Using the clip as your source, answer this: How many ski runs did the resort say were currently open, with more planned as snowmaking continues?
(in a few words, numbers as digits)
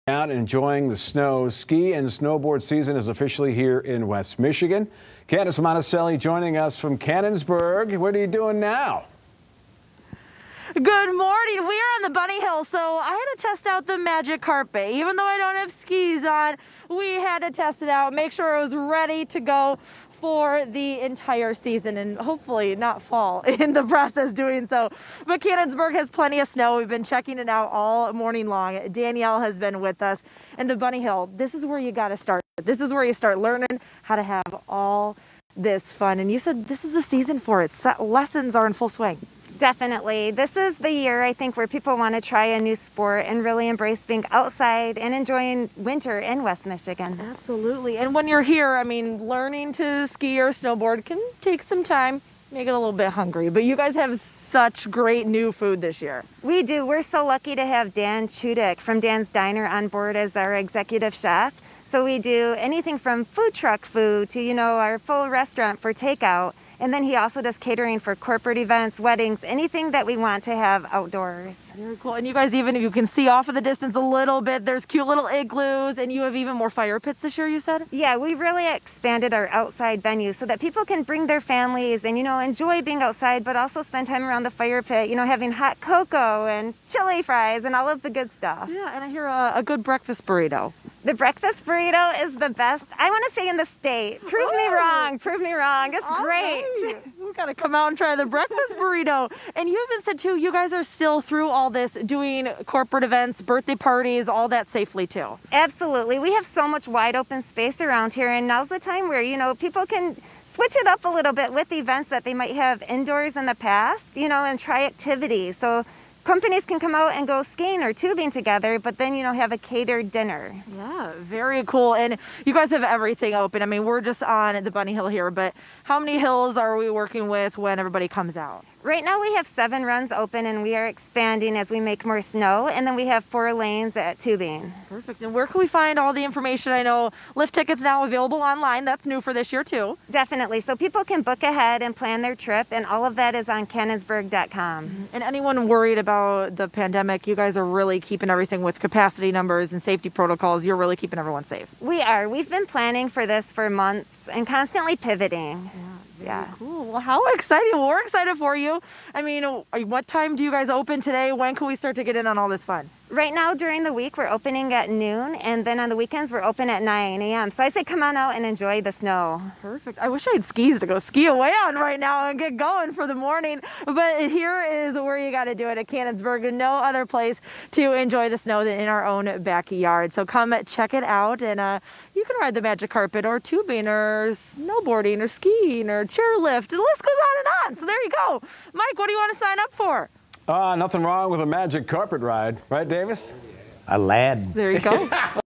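7.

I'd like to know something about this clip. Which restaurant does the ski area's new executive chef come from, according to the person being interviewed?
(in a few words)
Dan's Diner.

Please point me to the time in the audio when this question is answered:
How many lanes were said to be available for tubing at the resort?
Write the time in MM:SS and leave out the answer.
02:13.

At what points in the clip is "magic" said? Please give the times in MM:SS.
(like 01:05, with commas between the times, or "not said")
00:13, 03:02, 03:11.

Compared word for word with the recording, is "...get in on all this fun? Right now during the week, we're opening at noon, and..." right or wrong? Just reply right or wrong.
right.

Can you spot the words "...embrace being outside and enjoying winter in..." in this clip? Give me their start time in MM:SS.
00:43.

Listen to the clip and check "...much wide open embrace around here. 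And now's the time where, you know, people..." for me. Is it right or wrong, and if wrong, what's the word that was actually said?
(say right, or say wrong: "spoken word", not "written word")
wrong: "space", not "embrace".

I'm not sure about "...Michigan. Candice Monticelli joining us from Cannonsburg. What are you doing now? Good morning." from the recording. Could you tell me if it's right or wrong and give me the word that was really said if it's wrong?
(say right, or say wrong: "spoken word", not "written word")
right.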